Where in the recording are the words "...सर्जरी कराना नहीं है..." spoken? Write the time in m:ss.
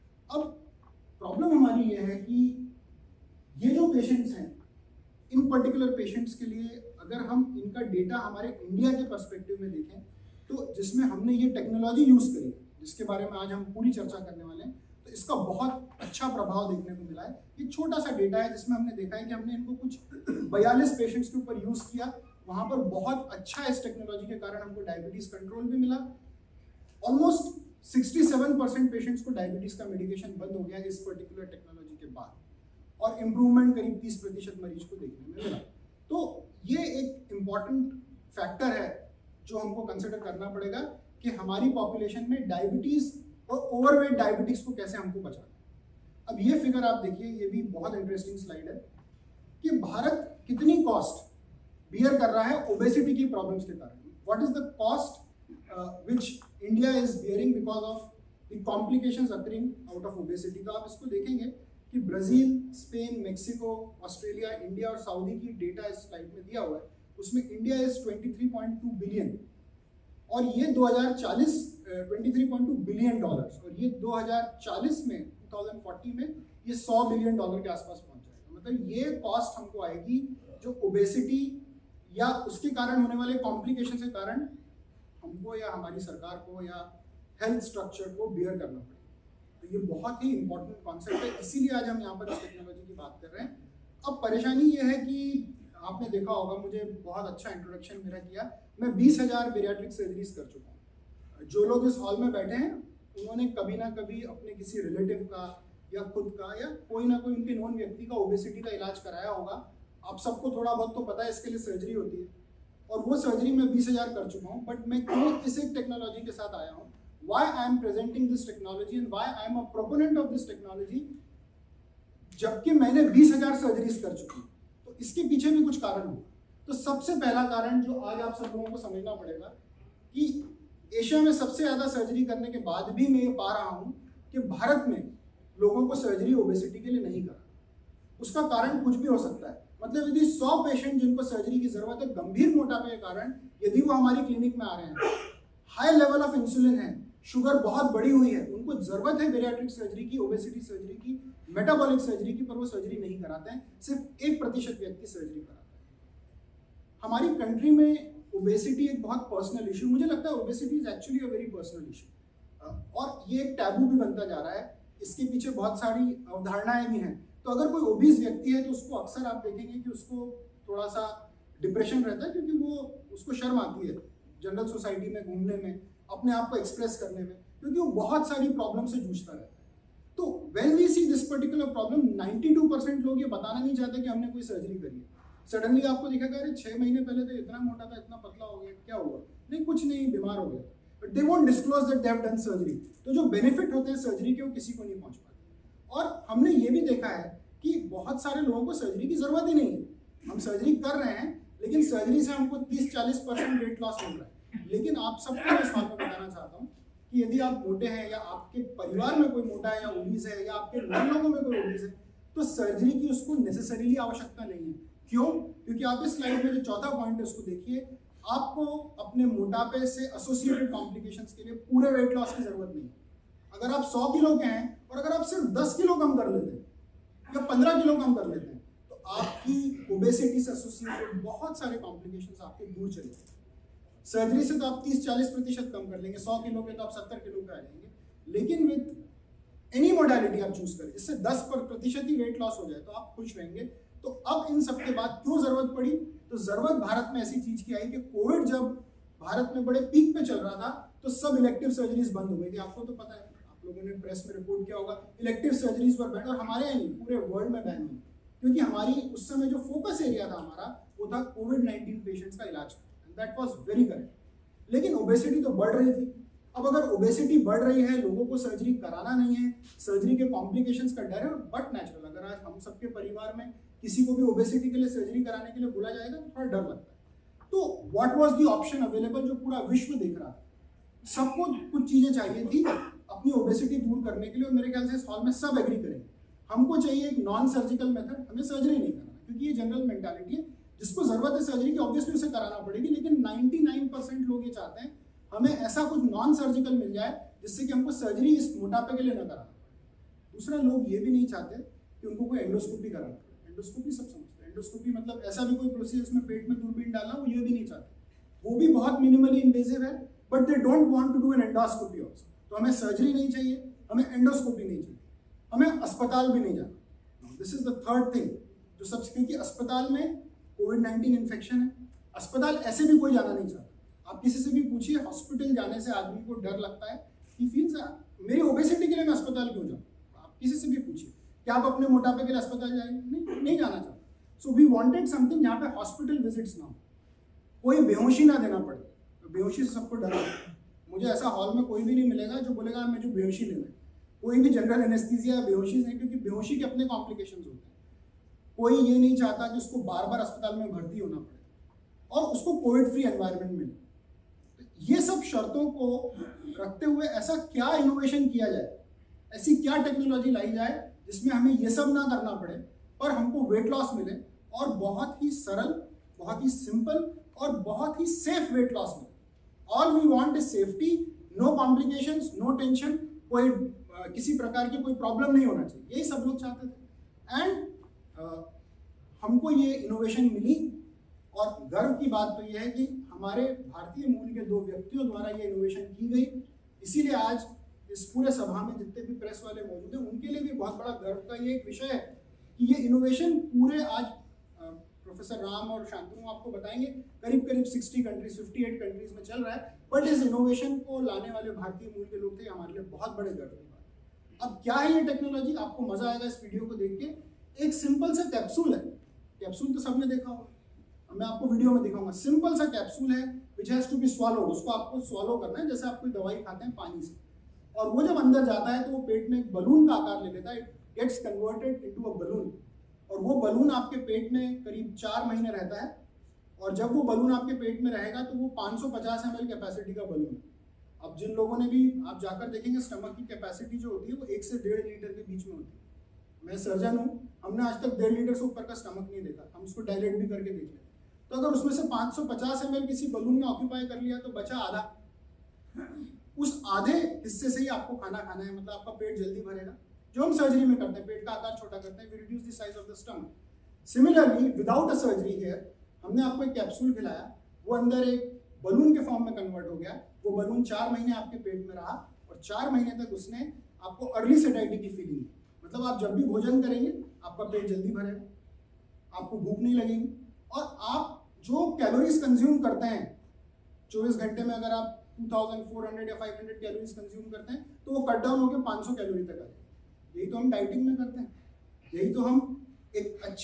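4:28.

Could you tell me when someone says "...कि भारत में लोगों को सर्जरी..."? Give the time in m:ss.
2:14.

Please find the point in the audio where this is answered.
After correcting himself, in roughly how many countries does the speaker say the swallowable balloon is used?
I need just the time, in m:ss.
6:38.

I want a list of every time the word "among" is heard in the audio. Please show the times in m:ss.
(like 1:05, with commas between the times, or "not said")
not said.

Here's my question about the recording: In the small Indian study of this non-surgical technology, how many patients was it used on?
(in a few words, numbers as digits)
42.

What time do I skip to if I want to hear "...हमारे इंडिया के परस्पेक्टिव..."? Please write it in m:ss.
0:08.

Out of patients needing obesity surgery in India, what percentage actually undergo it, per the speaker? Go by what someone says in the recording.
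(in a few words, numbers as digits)
1 percent.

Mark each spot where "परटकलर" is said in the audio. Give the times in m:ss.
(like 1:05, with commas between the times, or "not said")
0:05, 0:31, 3:01.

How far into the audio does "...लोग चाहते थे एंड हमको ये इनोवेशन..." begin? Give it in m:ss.
6:16.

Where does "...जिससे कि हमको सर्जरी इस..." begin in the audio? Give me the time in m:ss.
4:57.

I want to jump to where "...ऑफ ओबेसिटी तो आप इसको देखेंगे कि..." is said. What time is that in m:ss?
1:00.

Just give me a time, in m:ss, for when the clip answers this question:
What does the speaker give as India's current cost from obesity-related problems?
1:12.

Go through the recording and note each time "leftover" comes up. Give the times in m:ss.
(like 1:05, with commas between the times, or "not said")
not said.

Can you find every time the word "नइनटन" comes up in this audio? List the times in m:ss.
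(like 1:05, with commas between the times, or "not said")
4:21, 5:20.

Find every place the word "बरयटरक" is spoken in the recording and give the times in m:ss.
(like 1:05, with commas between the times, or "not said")
1:39, 2:29.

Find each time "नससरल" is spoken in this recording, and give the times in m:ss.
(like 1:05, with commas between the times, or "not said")
3:33.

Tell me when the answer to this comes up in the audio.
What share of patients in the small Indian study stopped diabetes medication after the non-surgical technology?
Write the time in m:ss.
0:27.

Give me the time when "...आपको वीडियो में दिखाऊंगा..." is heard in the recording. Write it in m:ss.
6:51.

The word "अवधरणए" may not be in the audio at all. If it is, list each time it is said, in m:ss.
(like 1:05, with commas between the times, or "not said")
2:46.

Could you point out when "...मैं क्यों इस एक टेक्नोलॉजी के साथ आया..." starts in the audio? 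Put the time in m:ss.
1:54.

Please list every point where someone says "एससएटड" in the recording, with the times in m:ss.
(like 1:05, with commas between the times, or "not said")
3:40, 3:50.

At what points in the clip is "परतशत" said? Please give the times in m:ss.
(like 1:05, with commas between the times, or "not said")
0:34, 2:34, 3:55, 4:01.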